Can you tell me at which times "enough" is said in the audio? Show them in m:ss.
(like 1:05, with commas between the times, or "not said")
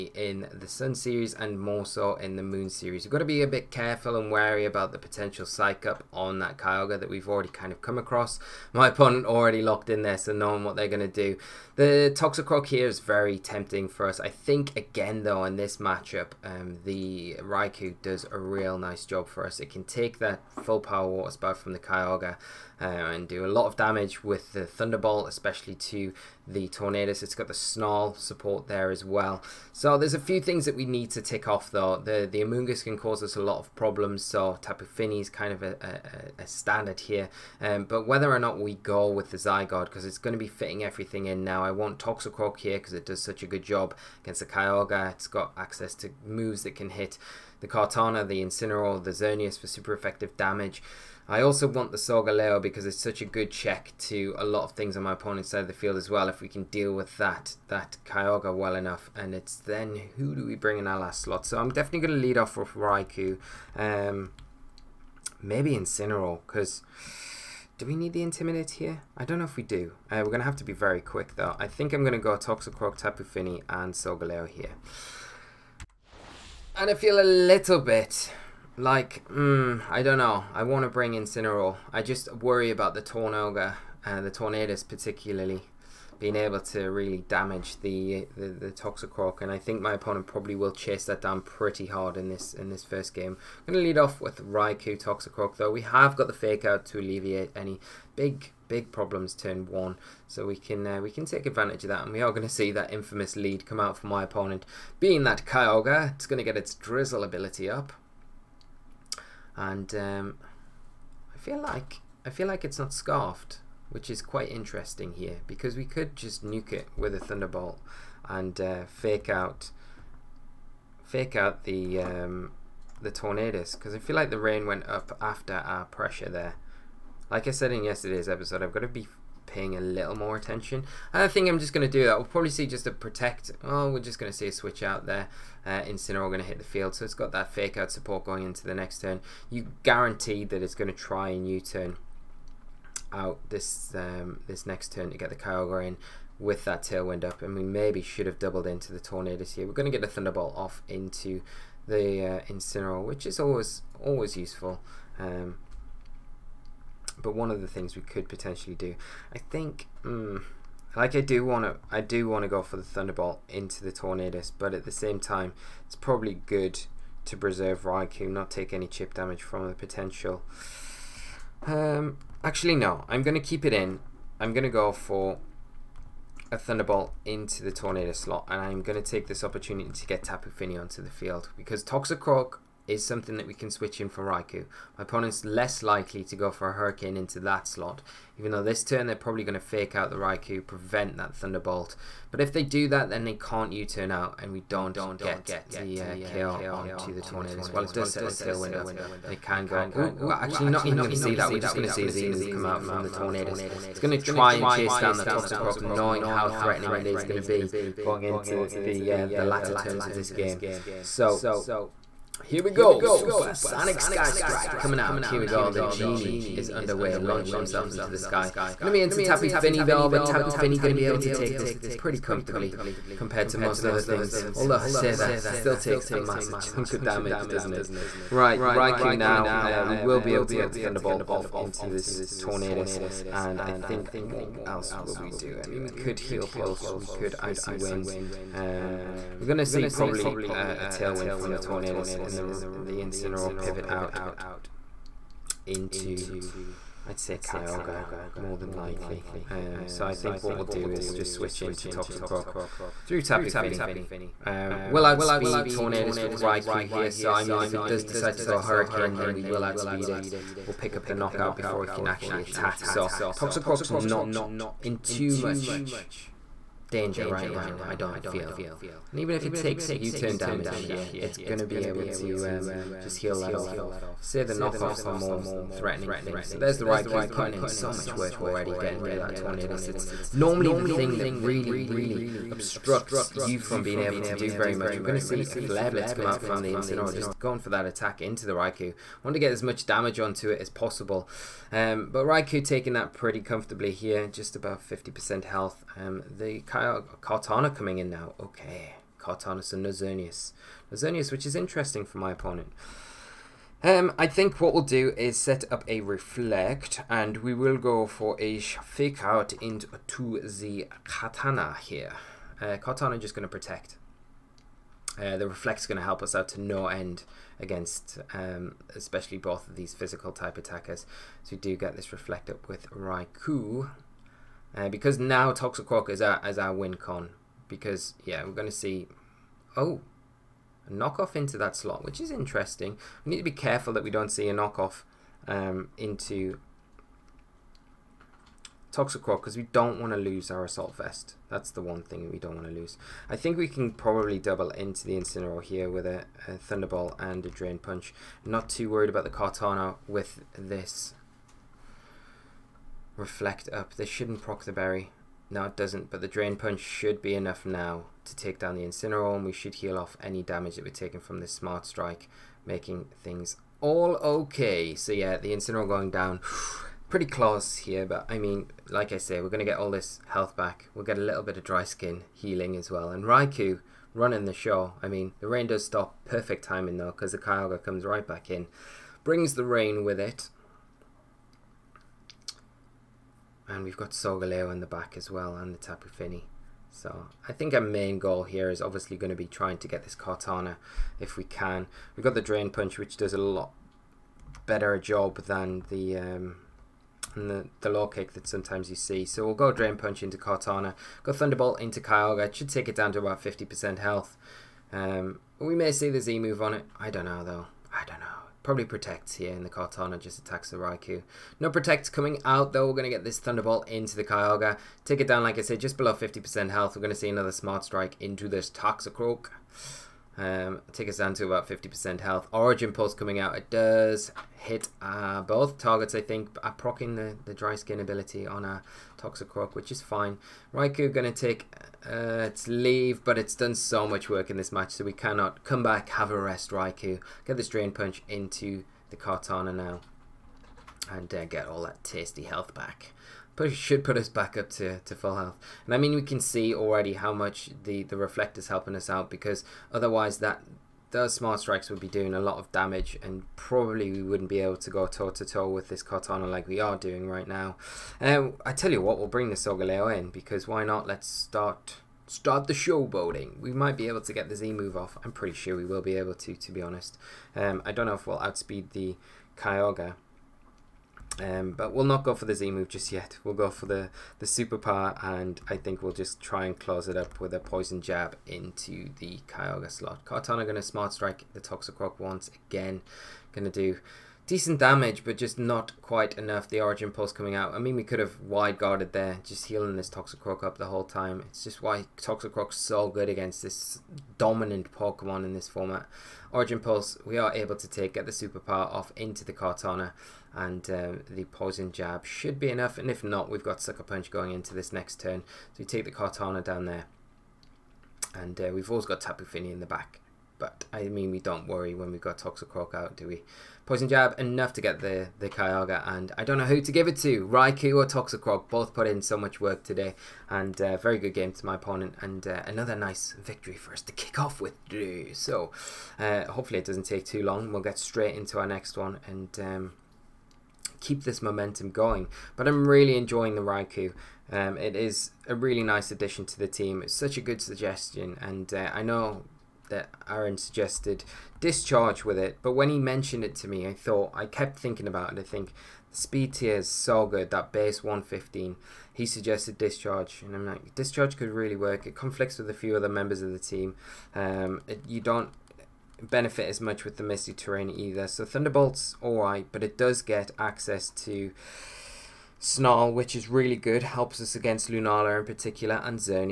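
0:58, 5:57, 8:06, 8:22, 8:34.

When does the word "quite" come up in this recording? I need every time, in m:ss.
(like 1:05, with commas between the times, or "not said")
1:54, 8:05.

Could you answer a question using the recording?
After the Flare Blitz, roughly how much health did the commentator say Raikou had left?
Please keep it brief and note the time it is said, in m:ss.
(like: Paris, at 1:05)
About 50%, at 4:54.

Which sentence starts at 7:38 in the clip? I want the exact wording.
Um, I tell you what, we'll bring the Solgaleo in because why not?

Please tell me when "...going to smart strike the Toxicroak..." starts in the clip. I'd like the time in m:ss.
8:00.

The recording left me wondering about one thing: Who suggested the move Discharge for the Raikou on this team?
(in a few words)
Aaron.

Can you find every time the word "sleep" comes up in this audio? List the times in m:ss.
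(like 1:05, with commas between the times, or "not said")
not said.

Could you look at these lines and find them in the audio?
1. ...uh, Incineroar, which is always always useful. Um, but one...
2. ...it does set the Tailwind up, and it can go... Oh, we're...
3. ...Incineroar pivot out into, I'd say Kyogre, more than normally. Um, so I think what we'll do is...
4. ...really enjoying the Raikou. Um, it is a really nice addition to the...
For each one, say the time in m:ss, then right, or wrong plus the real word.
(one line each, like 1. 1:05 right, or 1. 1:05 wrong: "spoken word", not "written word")
1. 2:32 right
2. 3:17 right
3. 4:02 wrong: "likely", not "normally"
4. 8:52 right.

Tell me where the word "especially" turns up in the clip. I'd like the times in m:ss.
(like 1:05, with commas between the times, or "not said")
0:25, 5:18.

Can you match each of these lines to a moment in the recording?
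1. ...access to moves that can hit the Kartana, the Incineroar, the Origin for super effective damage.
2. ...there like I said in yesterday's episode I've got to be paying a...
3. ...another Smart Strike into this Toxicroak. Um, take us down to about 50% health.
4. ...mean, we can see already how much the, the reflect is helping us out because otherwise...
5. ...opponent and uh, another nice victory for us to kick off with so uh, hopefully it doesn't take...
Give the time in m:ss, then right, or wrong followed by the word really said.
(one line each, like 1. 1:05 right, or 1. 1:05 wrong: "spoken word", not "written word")
1. 0:45 wrong: "Xerneas", not "Origin"
2. 2:06 right
3. 6:57 right
4. 7:25 right
5. 8:41 right.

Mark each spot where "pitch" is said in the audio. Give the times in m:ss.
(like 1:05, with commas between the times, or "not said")
not said.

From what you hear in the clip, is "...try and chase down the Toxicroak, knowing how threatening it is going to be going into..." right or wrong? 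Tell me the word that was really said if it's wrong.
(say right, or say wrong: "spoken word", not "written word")
right.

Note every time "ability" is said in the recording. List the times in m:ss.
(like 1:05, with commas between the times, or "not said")
1:47, 7:07.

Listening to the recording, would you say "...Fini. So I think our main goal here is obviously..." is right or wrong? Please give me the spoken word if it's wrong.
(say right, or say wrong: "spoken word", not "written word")
right.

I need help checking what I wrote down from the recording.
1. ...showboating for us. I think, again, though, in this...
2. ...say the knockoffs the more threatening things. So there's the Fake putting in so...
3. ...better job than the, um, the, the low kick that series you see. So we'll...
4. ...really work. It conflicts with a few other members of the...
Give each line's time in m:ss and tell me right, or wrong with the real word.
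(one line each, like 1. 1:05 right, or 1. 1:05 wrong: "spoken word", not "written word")
1. 0:13 wrong: "tempting", not "showboating"
2. 4:34 wrong: "Raikou", not "Fake"
3. 6:34 wrong: "sometimes", not "series"
4. 9:11 right.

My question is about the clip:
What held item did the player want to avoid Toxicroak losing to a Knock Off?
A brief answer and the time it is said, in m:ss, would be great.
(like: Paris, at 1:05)
Assault Vest, at 5:40.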